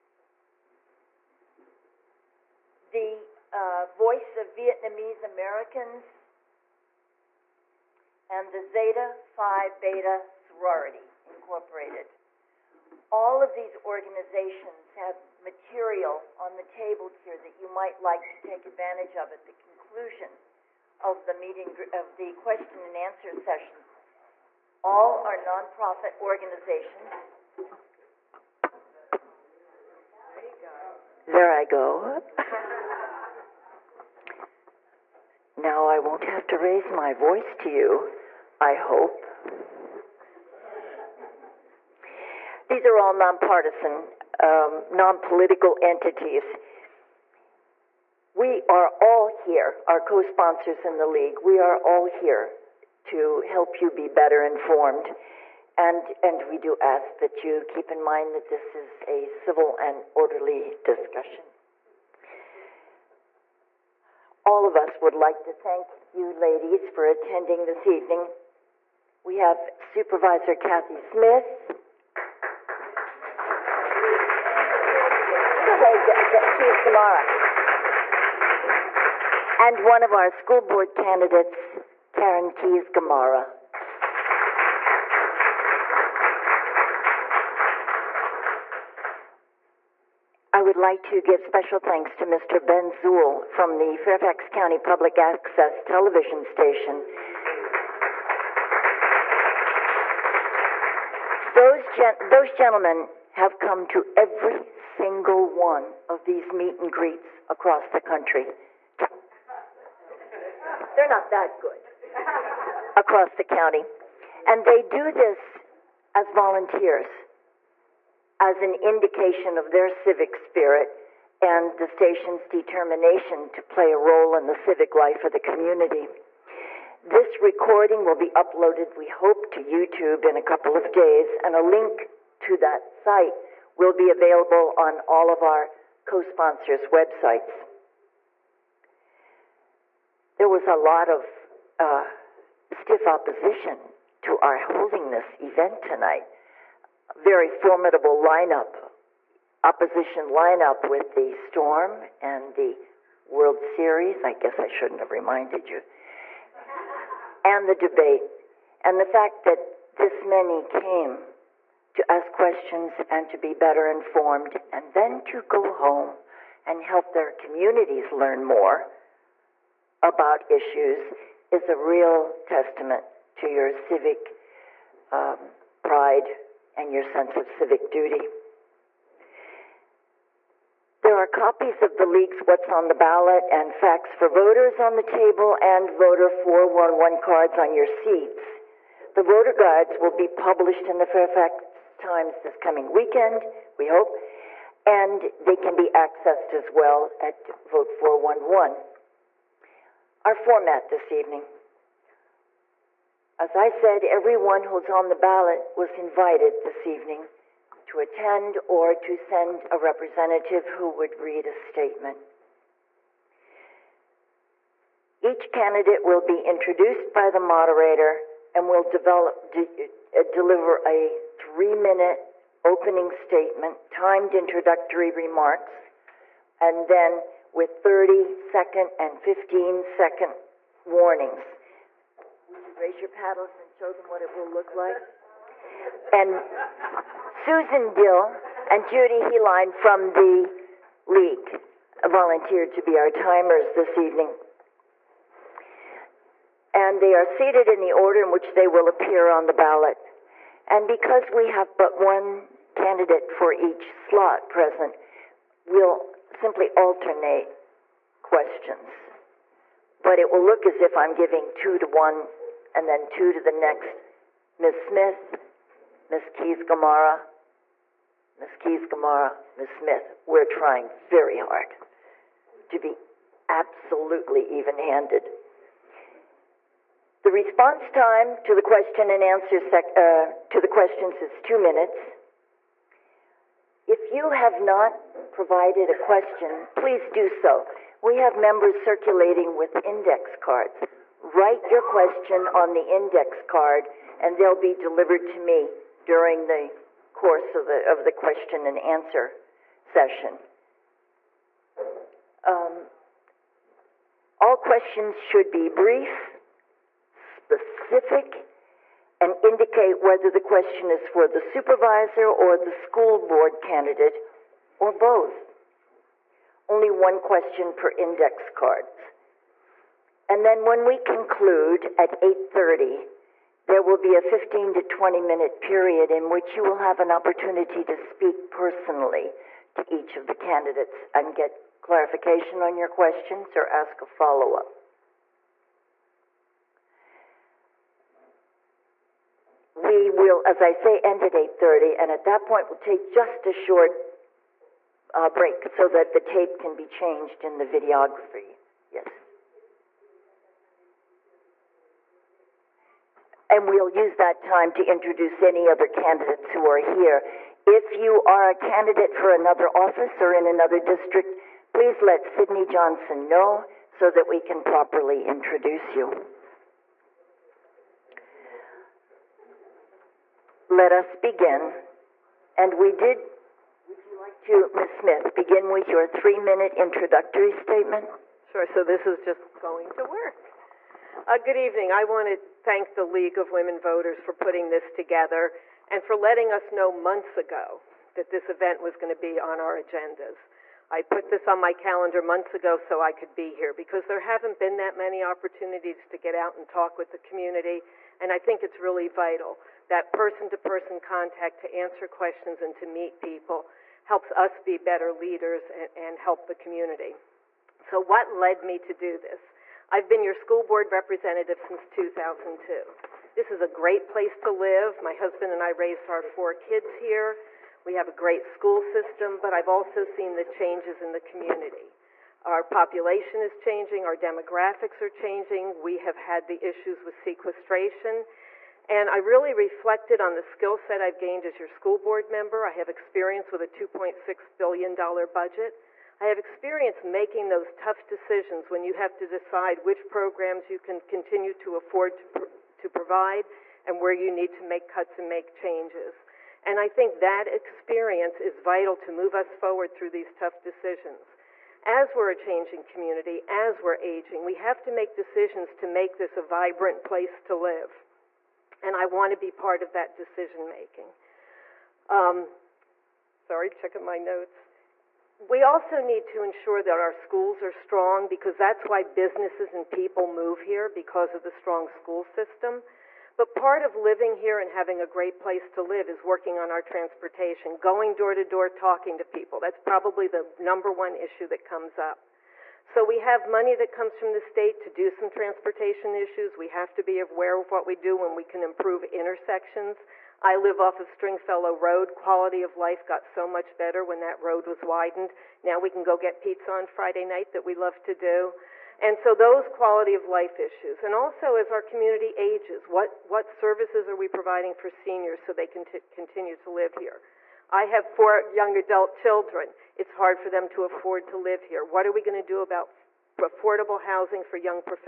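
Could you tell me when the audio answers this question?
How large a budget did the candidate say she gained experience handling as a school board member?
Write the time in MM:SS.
07:13.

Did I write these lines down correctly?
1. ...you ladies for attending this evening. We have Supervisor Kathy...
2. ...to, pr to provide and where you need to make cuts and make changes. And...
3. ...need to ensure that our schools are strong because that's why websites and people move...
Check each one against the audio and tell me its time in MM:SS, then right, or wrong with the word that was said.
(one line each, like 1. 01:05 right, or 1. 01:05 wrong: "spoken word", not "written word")
1. 01:06 right
2. 07:22 right
3. 07:46 wrong: "businesses", not "websites".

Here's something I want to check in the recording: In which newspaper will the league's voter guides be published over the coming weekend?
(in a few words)
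Fairfax Times.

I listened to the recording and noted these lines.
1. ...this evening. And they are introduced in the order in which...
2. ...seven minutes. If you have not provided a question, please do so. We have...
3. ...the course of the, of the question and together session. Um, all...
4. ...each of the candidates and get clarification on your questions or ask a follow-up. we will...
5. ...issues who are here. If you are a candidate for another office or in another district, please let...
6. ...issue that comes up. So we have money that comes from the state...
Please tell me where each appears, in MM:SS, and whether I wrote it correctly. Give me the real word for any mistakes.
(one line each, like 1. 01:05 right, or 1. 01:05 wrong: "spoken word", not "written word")
1. 04:03 wrong: "seated", not "introduced"
2. 04:41 wrong: "two", not "seven"
3. 04:56 wrong: "answer", not "together"
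4. 05:29 right
5. 05:55 wrong: "candidates", not "issues"
6. 08:01 right.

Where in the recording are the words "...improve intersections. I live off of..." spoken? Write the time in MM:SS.
08:08.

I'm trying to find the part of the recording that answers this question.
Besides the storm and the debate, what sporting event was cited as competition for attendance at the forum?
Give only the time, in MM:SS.
02:33.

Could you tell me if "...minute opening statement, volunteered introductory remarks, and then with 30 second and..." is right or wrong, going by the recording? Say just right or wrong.
wrong.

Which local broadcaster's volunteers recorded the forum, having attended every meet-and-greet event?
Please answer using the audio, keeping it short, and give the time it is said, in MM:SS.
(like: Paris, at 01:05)
Fairfax County Public Access Television, at 01:33.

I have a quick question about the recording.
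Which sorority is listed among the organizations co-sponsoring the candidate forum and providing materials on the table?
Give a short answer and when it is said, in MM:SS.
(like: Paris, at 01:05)
Zeta Phi Beta Sorority, at 00:08.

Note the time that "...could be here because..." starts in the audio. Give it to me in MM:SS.
06:33.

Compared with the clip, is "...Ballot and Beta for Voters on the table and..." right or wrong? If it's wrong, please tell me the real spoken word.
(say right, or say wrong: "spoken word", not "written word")
wrong: "Facts", not "Beta".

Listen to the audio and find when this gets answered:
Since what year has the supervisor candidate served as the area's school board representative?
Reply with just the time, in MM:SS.
06:51.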